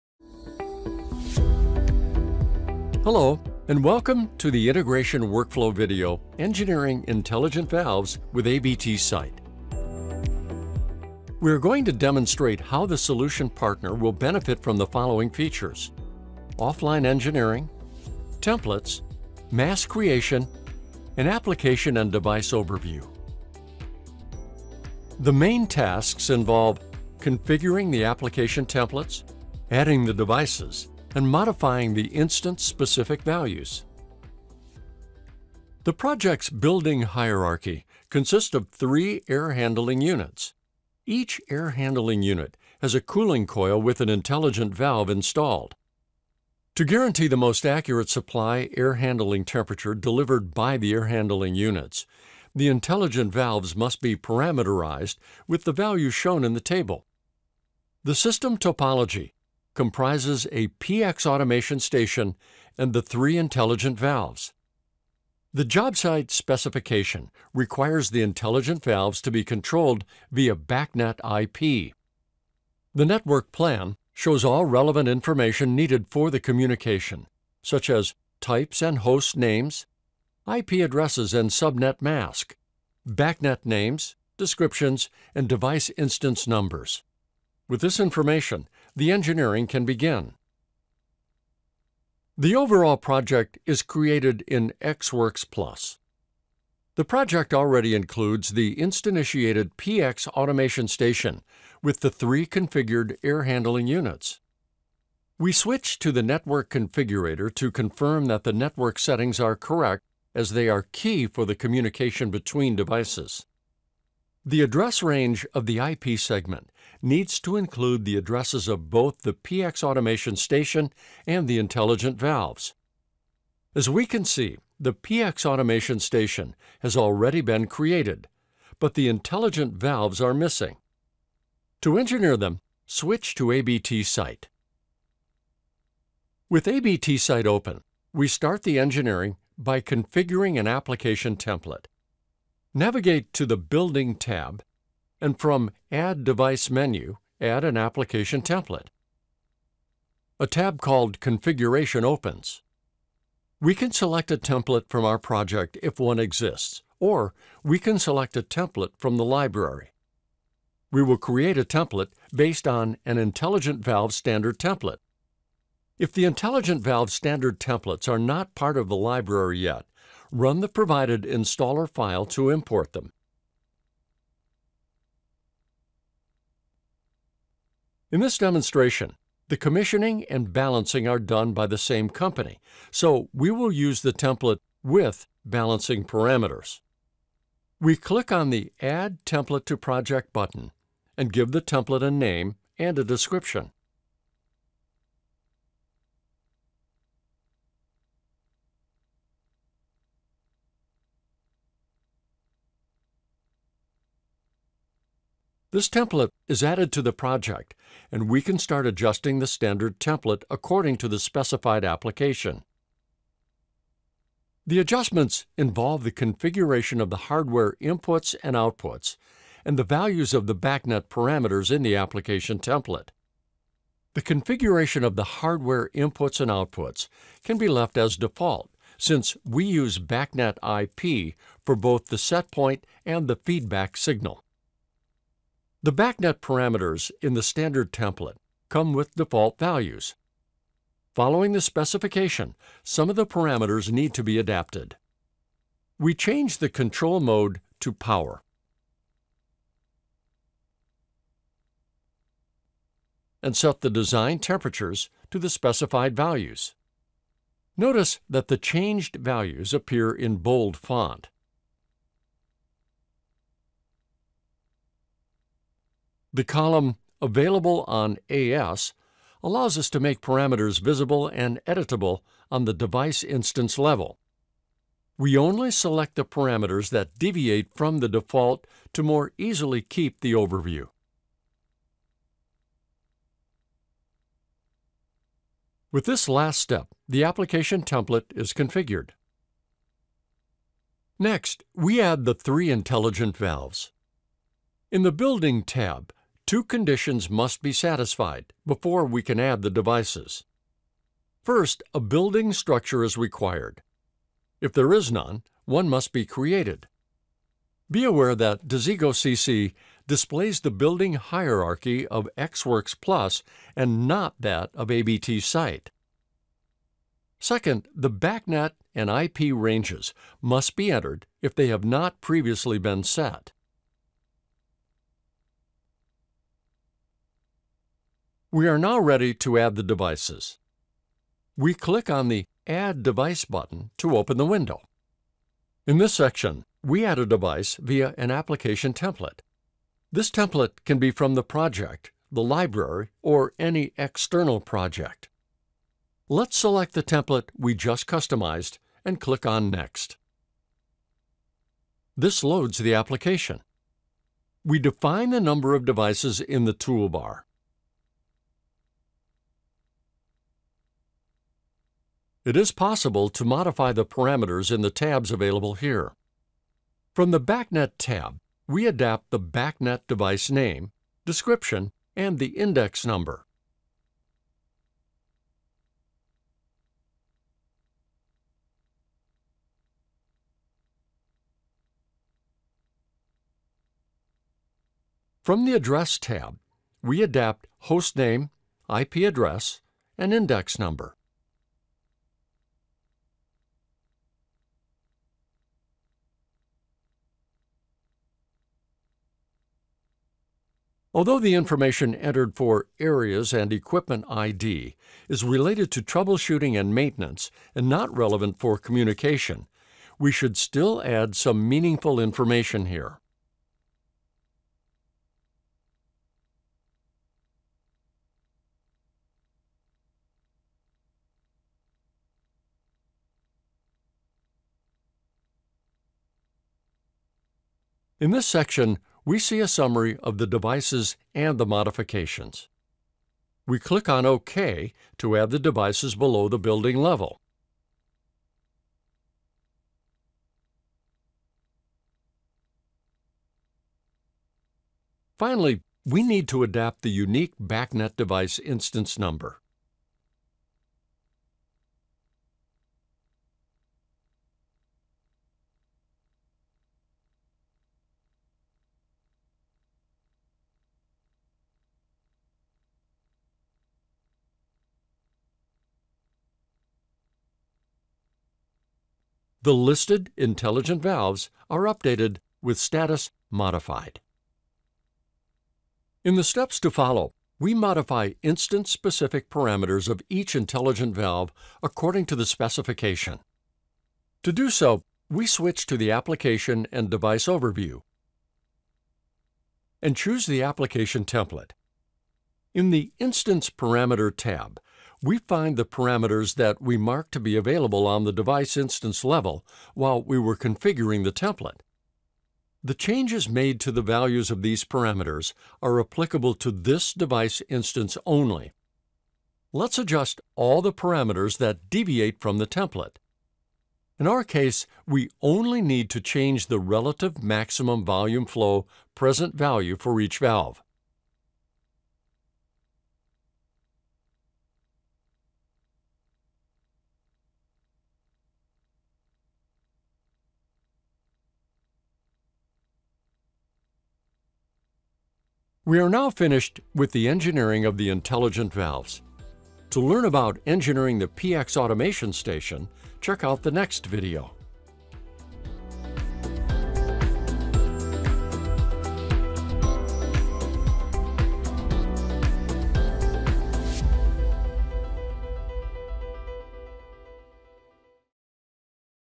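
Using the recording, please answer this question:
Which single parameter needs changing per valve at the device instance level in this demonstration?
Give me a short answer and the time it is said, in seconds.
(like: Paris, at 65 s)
relative maximum volume flow, at 516 s.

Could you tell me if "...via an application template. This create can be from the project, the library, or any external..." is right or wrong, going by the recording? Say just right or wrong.
wrong.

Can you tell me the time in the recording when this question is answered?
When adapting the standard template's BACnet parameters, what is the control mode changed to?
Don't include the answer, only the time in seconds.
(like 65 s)
247 s.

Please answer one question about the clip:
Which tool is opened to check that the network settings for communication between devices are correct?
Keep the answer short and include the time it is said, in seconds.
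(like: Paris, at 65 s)
network configurator, at 106 s.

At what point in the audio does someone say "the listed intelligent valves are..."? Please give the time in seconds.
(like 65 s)
469 s.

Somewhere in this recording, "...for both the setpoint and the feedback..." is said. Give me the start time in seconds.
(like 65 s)
231 s.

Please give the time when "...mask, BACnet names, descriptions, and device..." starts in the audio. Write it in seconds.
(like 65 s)
82 s.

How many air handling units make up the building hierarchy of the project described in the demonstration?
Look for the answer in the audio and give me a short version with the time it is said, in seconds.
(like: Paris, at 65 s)
3, at 38 s.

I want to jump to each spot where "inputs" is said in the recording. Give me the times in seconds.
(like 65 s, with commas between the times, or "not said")
217 s, 225 s.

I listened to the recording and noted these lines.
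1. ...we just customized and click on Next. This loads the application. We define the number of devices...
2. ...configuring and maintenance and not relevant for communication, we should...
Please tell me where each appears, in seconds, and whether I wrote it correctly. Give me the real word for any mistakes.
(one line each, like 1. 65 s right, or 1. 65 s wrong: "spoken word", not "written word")
1. 347 s right
2. 406 s wrong: "troubleshooting", not "configuring".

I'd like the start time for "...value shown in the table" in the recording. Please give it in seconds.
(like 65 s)
55 s.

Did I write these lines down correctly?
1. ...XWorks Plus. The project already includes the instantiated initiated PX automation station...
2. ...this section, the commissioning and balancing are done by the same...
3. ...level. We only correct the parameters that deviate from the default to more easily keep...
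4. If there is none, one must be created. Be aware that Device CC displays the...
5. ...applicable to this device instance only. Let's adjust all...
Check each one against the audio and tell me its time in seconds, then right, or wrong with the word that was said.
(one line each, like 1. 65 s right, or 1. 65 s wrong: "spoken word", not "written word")
1. 94 s right
2. 178 s wrong: "demonstration", not "section"
3. 273 s wrong: "select", not "correct"
4. 304 s wrong: "Desigo", not "Device"
5. 505 s right.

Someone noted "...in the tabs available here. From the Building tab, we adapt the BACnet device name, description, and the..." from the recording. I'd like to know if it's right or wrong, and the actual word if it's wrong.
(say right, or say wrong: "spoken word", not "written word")
wrong: "BACnet", not "Building".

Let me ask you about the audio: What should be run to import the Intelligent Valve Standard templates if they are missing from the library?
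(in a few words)
provided installer file.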